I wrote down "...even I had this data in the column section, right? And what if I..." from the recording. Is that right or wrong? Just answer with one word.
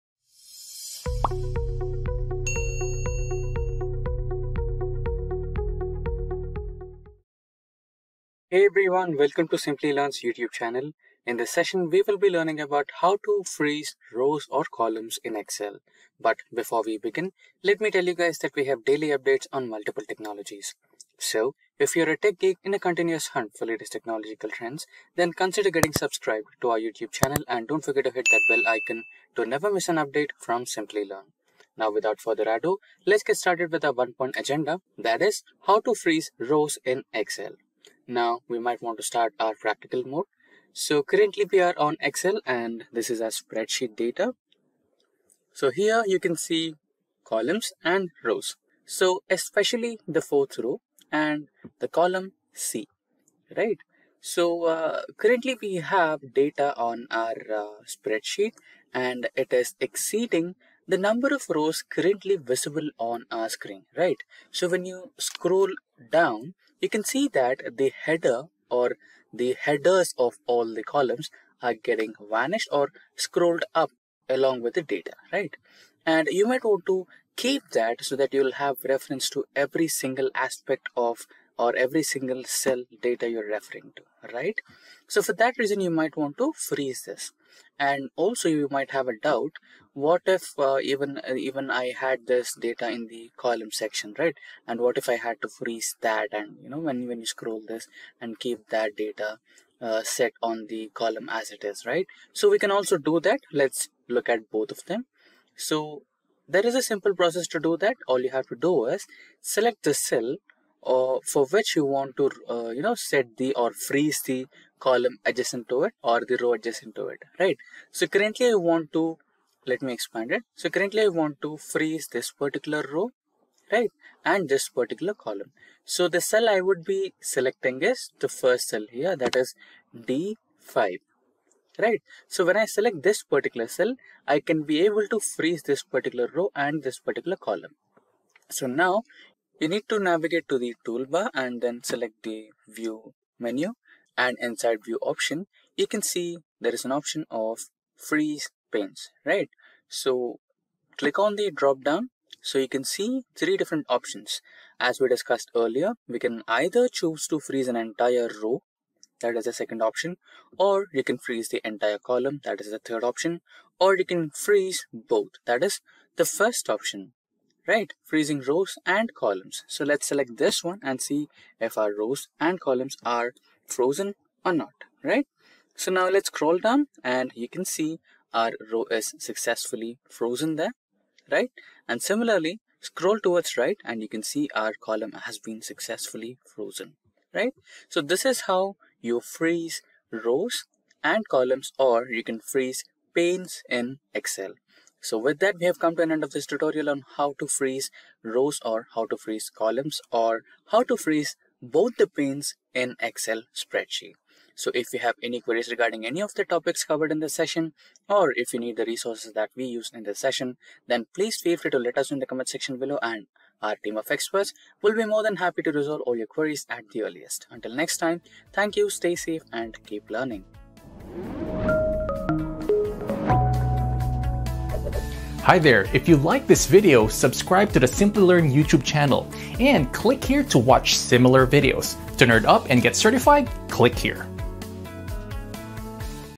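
right.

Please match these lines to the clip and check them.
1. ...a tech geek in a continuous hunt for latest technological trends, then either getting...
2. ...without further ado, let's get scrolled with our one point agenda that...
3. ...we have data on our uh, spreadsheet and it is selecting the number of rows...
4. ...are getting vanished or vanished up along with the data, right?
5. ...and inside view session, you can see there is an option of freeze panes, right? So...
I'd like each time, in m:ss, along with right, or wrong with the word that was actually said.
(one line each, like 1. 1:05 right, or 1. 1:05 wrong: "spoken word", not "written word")
1. 0:22 wrong: "consider", not "either"
2. 0:31 wrong: "started", not "scrolled"
3. 0:55 wrong: "exceeding", not "selecting"
4. 1:11 wrong: "scrolled", not "vanished"
5. 2:24 wrong: "option", not "session".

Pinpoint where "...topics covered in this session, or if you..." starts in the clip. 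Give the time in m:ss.
3:26.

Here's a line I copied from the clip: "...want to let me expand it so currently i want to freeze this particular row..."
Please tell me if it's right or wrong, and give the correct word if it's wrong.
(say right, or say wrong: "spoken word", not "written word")
right.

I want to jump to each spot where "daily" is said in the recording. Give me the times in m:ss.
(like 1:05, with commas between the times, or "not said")
0:18.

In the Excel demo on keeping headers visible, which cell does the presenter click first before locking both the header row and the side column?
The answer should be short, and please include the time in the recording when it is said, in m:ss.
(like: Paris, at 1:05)
D5, at 2:10.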